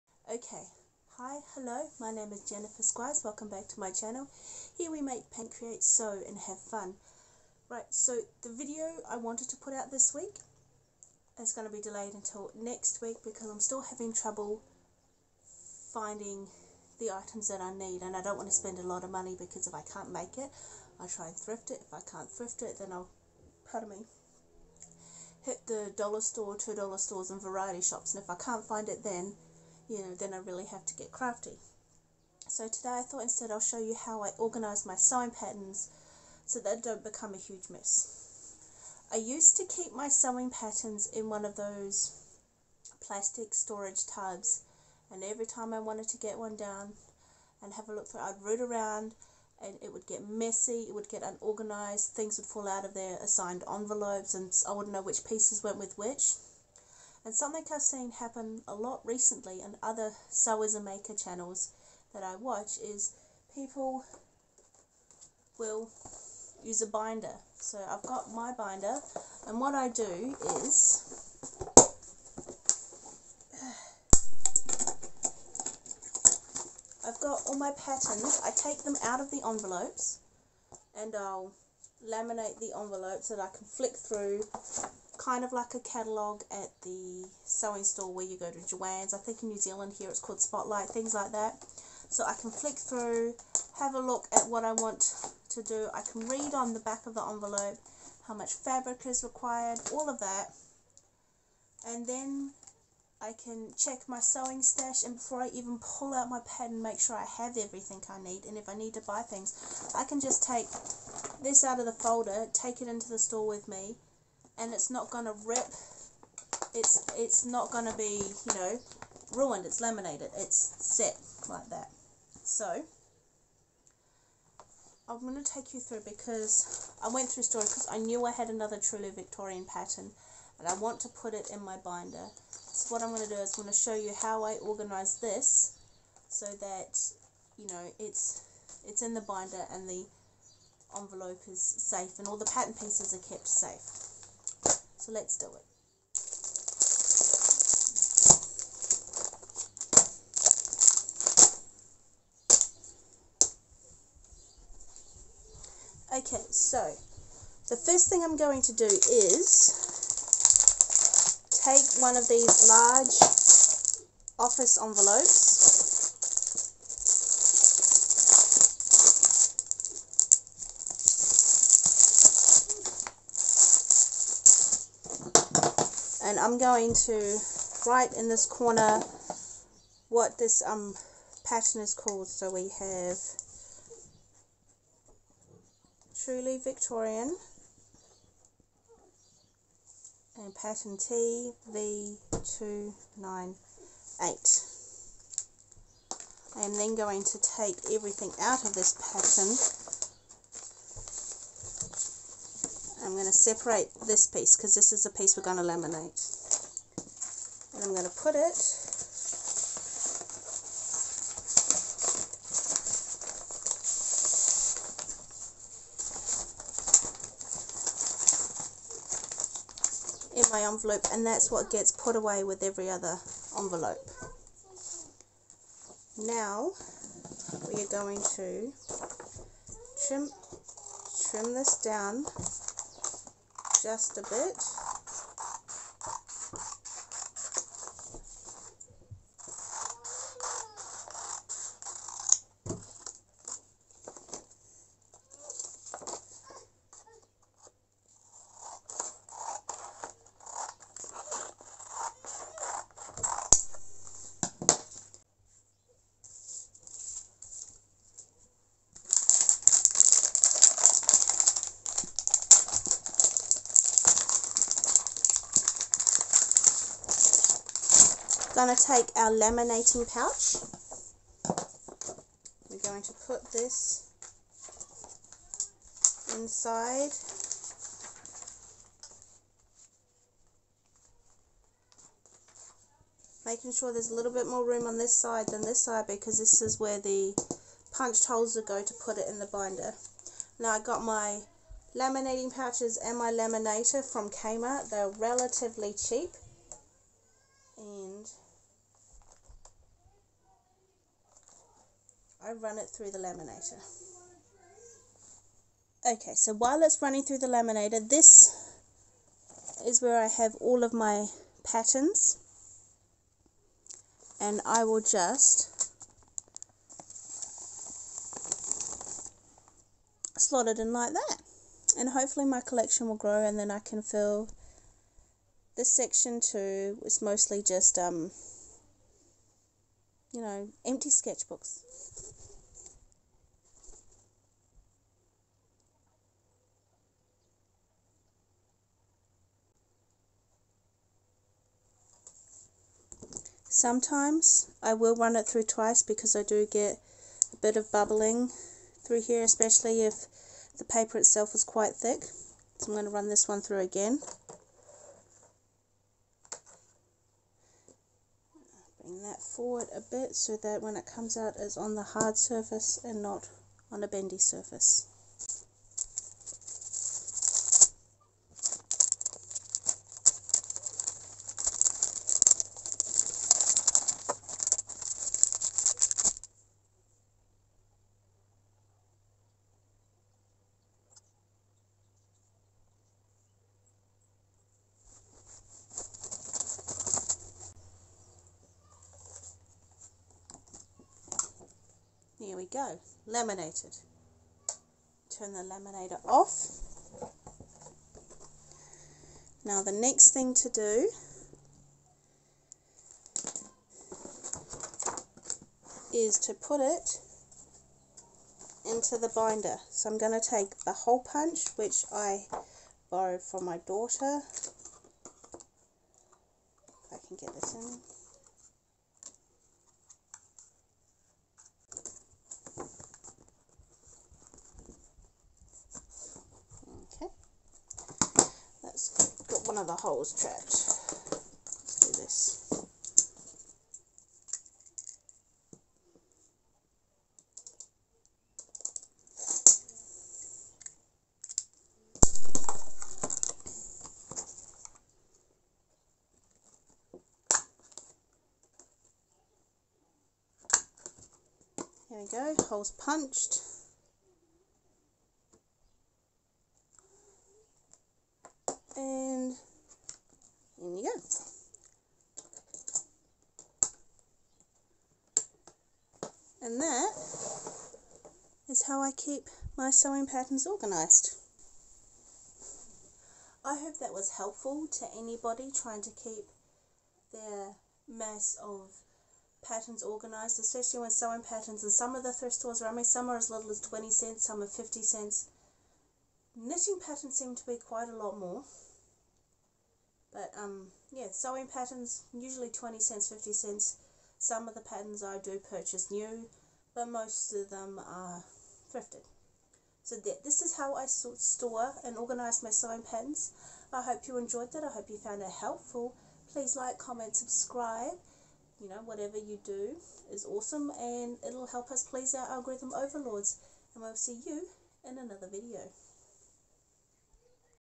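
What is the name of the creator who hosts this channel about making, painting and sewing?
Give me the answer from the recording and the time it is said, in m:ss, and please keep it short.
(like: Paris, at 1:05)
Jennifer Squires, at 0:02.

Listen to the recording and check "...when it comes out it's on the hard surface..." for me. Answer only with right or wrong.
right.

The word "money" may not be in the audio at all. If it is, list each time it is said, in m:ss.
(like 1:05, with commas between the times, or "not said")
0:19.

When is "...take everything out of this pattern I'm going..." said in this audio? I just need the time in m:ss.
3:17.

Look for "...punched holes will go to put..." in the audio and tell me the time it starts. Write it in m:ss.
4:47.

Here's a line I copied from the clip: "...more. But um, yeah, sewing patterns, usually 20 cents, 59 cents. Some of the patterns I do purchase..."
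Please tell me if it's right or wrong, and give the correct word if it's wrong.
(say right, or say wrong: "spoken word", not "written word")
wrong: "50", not "59".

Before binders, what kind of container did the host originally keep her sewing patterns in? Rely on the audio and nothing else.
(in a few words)
plastic storage tubs.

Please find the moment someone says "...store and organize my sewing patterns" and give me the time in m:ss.
8:21.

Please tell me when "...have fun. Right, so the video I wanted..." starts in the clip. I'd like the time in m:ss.
0:06.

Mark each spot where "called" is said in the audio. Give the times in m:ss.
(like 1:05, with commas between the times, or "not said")
1:30, 3:01.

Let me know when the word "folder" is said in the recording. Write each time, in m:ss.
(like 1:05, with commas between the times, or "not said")
1:51.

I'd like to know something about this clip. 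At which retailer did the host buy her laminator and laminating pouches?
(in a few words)
Kmart.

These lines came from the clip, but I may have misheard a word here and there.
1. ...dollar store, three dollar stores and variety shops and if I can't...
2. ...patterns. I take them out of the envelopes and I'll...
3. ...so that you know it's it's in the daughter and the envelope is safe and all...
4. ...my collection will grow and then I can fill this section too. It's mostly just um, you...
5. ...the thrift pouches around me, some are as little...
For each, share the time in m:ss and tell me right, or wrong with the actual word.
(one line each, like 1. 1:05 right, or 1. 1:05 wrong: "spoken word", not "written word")
1. 0:25 wrong: "two", not "three"
2. 1:17 right
3. 2:16 wrong: "binder", not "daughter"
4. 5:22 right
5. 8:02 wrong: "stores", not "pouches".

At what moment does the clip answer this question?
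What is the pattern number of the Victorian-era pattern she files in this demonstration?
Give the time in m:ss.
3:10.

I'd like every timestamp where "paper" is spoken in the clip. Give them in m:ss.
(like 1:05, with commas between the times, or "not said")
5:50.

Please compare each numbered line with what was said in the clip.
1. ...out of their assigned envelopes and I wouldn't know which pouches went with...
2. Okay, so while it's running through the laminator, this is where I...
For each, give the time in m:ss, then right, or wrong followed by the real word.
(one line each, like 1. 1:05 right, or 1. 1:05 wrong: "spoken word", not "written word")
1. 0:52 wrong: "pieces", not "pouches"
2. 5:06 right.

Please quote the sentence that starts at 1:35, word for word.
I can read on the back of the envelope how much fabric is required, all of that.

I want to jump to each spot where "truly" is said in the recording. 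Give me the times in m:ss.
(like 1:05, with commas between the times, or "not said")
2:08, 3:06.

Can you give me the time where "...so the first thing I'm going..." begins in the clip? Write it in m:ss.
2:36.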